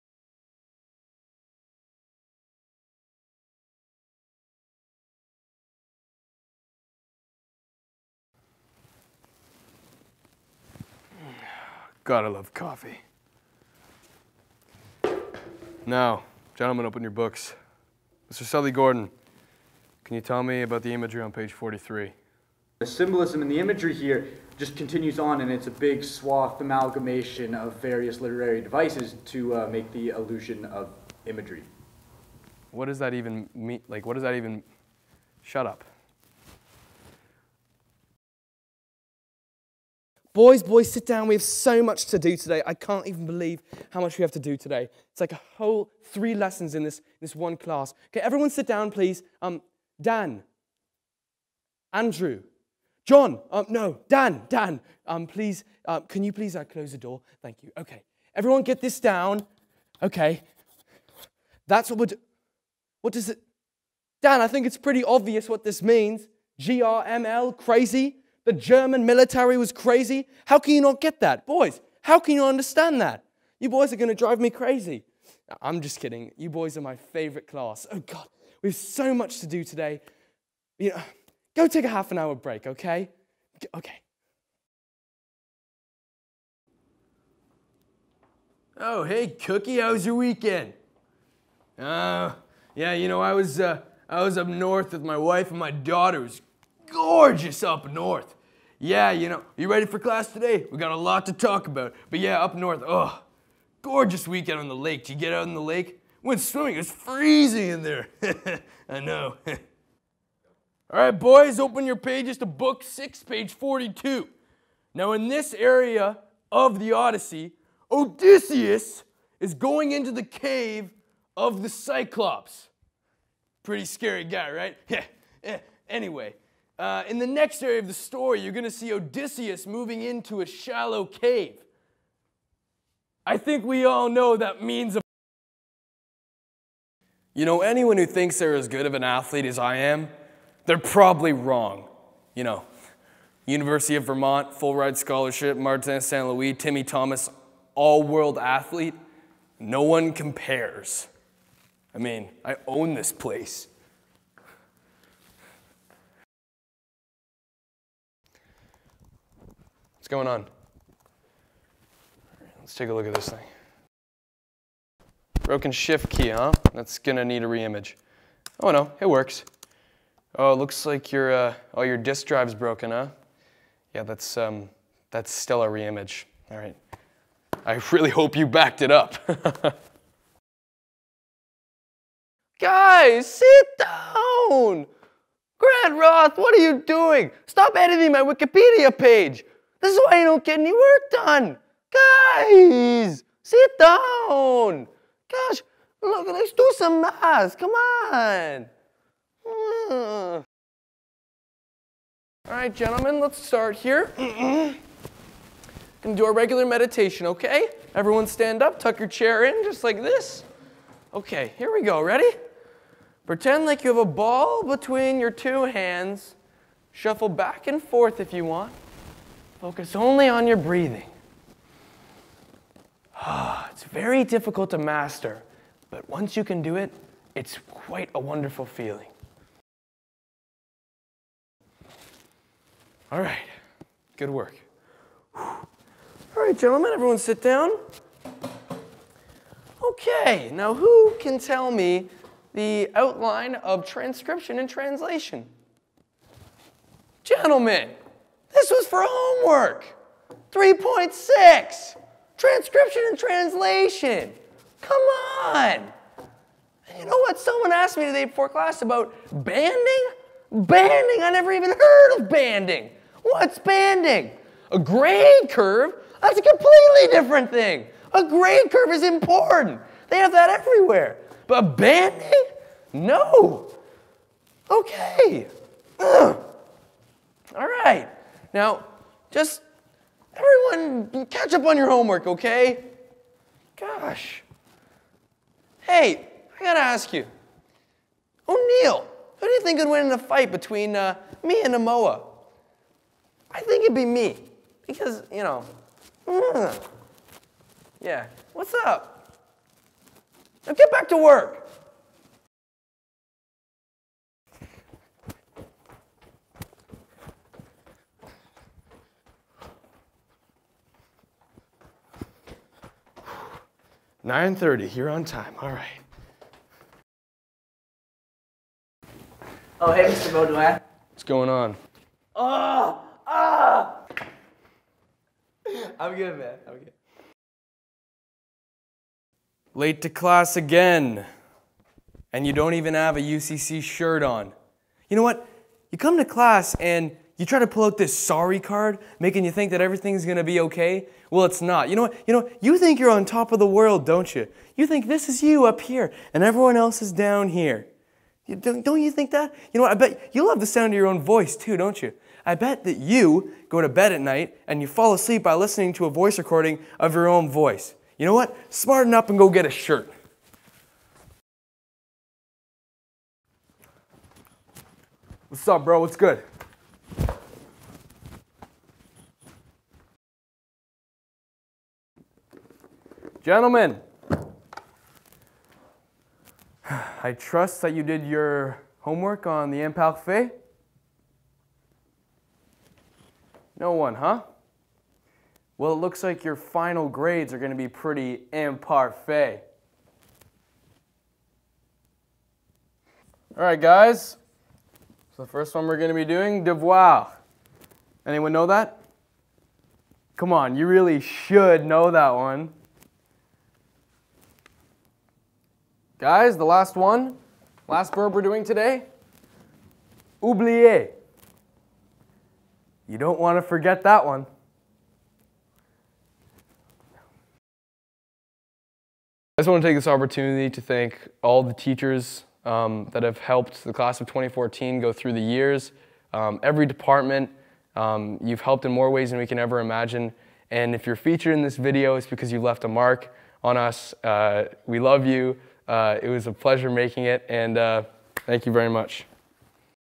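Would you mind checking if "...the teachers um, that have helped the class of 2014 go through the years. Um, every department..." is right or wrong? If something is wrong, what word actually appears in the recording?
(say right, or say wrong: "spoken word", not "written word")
right.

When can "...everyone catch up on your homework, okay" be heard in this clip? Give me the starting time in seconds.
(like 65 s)
280 s.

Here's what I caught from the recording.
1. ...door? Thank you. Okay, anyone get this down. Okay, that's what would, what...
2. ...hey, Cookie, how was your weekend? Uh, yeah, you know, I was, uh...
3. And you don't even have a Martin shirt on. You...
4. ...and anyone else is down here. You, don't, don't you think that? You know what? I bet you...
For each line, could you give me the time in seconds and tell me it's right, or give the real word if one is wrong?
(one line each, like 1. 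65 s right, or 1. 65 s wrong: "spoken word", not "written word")
1. 56 s wrong: "everyone", not "anyone"
2. 89 s right
3. 332 s wrong: "UCC", not "Martin"
4. 346 s wrong: "everyone", not "anyone".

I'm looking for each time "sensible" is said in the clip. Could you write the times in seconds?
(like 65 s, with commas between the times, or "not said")
not said.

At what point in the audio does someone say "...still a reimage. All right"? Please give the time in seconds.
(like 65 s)
175 s.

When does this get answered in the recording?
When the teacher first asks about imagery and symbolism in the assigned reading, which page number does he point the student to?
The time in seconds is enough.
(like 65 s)
21 s.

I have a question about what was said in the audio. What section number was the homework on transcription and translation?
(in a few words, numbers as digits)
3.6.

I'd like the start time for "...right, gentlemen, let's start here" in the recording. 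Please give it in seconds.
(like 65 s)
202 s.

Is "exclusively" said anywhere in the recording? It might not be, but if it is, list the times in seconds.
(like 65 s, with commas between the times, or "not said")
not said.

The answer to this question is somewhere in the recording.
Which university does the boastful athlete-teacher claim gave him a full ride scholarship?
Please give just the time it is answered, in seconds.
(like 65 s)
143 s.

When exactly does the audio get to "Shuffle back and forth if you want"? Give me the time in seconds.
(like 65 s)
216 s.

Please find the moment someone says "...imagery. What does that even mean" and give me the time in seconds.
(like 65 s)
31 s.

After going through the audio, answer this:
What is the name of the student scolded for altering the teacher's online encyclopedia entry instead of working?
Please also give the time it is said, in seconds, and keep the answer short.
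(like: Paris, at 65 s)
Grant Roth, at 185 s.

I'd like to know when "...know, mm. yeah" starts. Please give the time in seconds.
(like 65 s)
295 s.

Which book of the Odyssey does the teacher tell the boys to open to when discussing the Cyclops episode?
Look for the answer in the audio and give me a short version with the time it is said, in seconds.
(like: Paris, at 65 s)
book six, at 112 s.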